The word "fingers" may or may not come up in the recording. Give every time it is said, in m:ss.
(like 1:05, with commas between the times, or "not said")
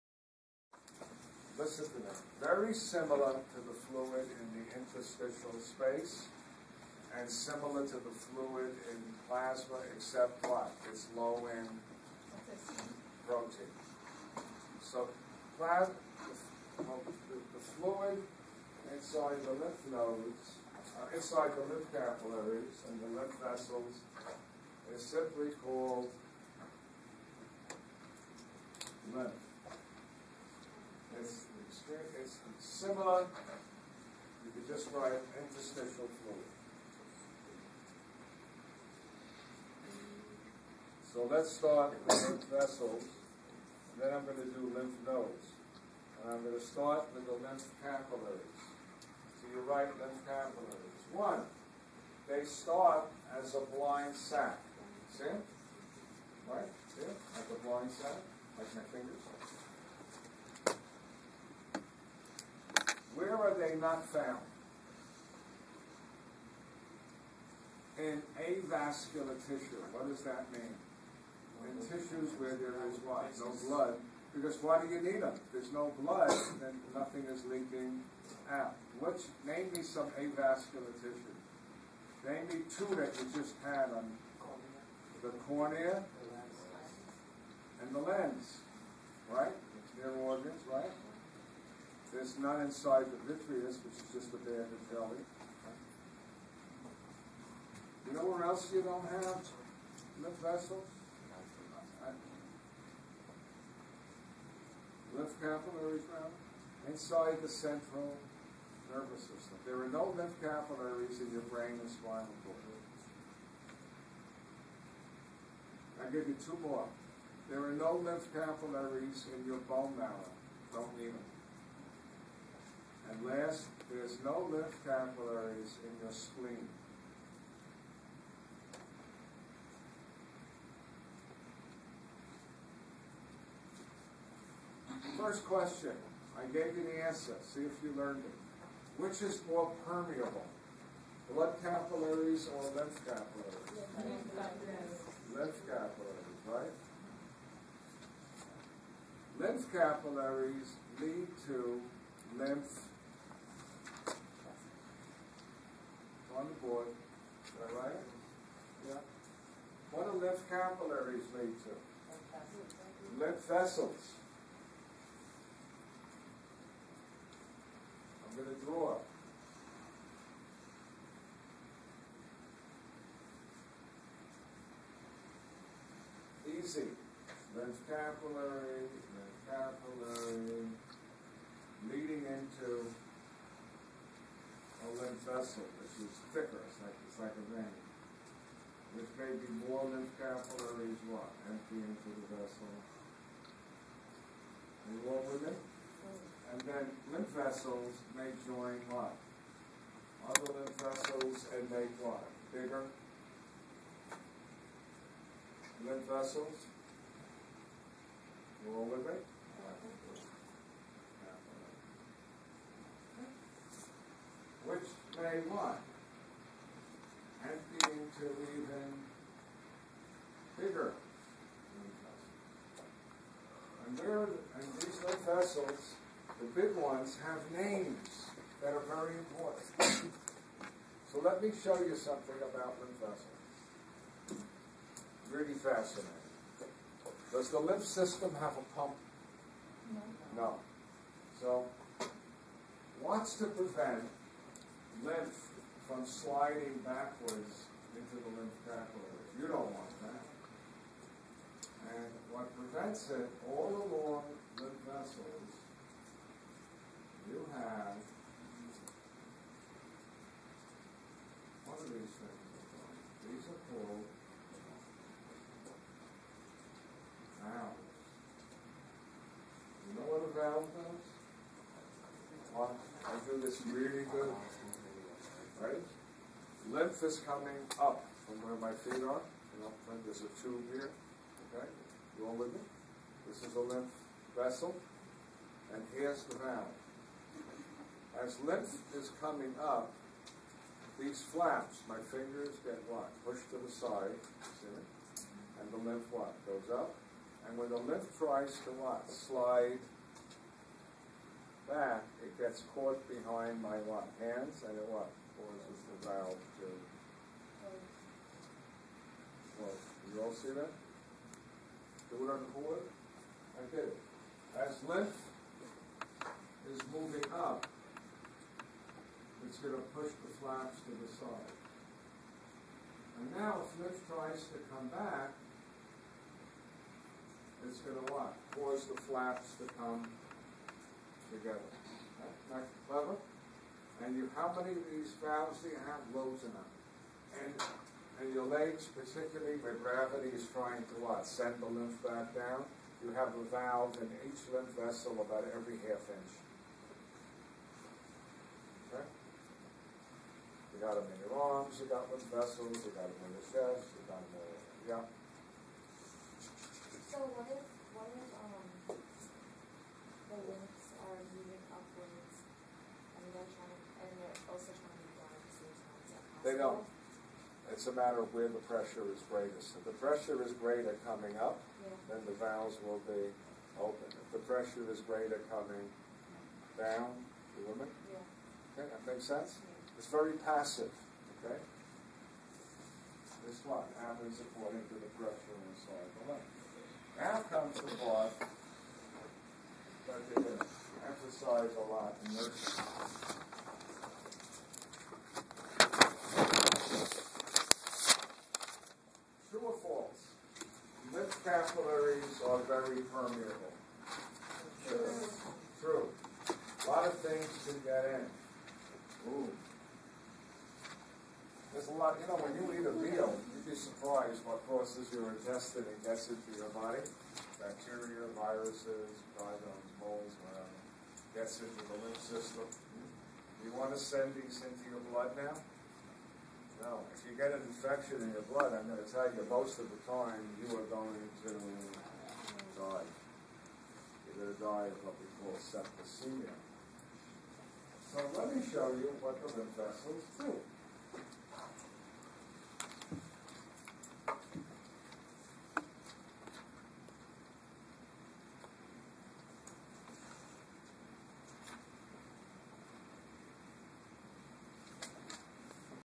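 0:58, 4:52.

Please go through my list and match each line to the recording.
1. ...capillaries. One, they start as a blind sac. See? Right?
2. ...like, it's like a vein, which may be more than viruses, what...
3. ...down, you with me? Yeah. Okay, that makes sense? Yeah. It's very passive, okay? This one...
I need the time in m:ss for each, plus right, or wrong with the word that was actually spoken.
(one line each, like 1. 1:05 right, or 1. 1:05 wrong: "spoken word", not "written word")
1. 0:50 right
2. 3:06 wrong: "capillaries", not "viruses"
3. 6:16 right.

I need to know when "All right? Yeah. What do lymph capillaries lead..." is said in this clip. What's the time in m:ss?
2:37.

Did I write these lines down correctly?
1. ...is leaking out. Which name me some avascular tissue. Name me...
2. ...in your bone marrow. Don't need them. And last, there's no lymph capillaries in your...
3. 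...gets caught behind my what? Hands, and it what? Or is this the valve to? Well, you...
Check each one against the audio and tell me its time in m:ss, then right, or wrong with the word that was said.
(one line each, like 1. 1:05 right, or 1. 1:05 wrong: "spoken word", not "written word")
1. 1:17 right
2. 1:59 right
3. 5:02 right.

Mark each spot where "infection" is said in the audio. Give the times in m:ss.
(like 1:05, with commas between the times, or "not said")
7:07.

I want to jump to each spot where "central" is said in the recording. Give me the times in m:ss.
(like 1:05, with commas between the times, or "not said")
1:47.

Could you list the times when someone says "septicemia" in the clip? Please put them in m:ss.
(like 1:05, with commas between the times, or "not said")
7:15.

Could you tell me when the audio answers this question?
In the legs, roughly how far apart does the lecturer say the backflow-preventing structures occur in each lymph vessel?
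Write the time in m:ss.
5:45.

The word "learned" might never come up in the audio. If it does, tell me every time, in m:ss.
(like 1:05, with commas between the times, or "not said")
2:17.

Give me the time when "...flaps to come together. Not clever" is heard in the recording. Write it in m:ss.
5:28.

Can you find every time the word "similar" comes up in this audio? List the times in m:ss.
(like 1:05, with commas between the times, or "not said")
0:02, 0:07, 0:32.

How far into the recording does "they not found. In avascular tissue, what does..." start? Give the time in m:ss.
1:03.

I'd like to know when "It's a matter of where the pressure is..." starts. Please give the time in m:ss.
6:07.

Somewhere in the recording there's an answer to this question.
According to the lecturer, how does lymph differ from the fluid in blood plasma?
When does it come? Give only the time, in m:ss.
0:11.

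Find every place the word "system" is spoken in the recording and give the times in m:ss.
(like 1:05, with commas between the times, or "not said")
1:49, 3:57, 7:02.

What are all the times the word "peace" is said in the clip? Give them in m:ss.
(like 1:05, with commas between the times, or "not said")
not said.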